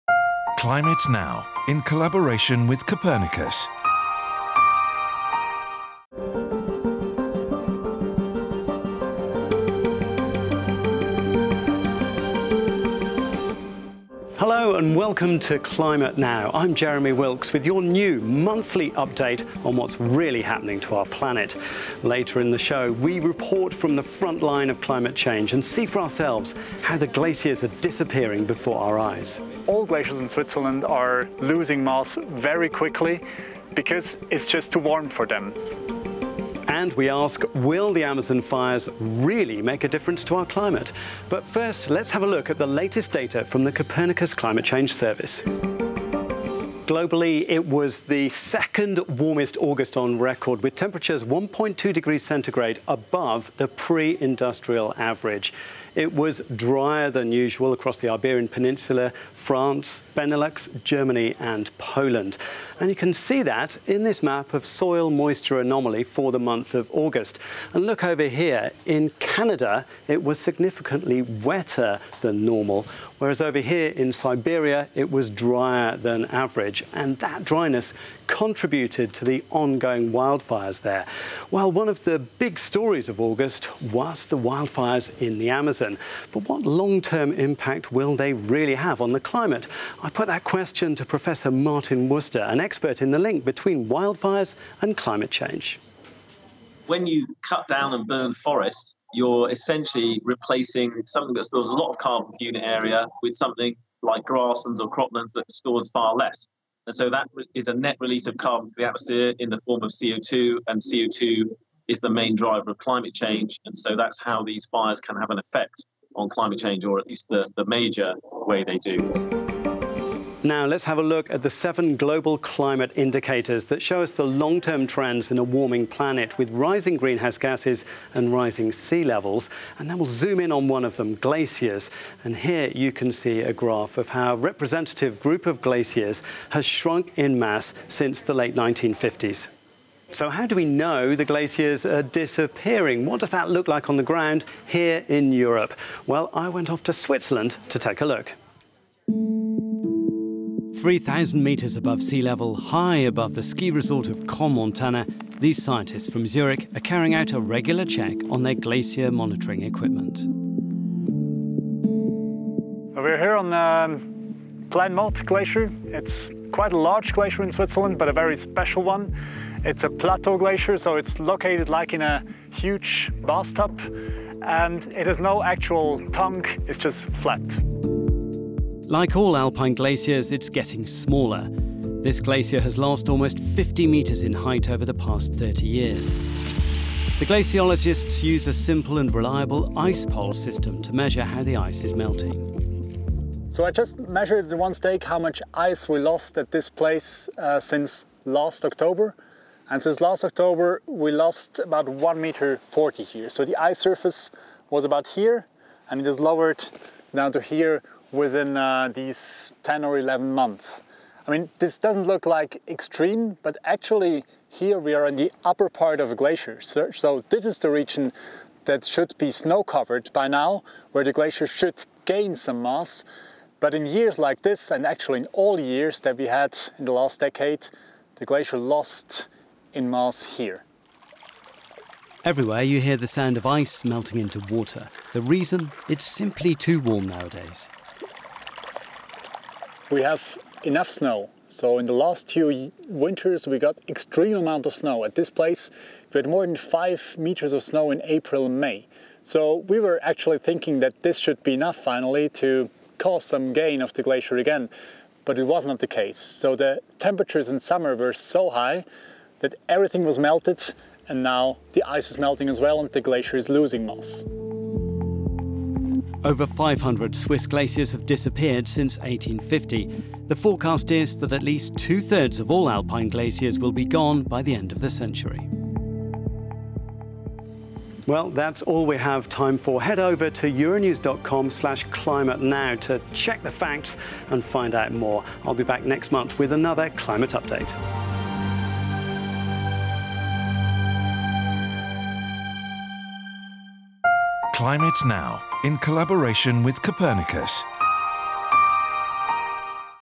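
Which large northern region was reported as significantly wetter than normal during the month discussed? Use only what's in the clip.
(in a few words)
Canada.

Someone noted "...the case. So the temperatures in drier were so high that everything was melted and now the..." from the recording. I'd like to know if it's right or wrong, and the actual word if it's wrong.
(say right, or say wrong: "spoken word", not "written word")
wrong: "summer", not "drier".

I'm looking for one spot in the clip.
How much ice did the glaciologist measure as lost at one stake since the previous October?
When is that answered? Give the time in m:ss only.
3:21.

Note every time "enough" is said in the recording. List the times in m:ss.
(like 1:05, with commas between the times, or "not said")
4:00, 4:11.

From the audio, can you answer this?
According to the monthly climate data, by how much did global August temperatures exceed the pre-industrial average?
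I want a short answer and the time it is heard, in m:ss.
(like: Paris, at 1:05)
1.2 degrees centigrade, at 0:51.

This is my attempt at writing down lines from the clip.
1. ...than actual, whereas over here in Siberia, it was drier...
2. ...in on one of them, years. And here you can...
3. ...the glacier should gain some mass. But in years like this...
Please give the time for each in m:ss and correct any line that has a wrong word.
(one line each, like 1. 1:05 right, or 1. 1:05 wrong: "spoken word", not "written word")
1. 1:12 wrong: "normal", not "actual"
2. 2:10 wrong: "glaciers", not "years"
3. 3:41 right.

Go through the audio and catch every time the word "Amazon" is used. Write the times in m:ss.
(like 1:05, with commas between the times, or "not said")
0:38, 1:25.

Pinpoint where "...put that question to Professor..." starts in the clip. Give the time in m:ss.
1:30.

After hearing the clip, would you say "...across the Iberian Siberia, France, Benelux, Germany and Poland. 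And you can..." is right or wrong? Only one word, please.
wrong.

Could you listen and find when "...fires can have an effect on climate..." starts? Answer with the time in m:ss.
1:54.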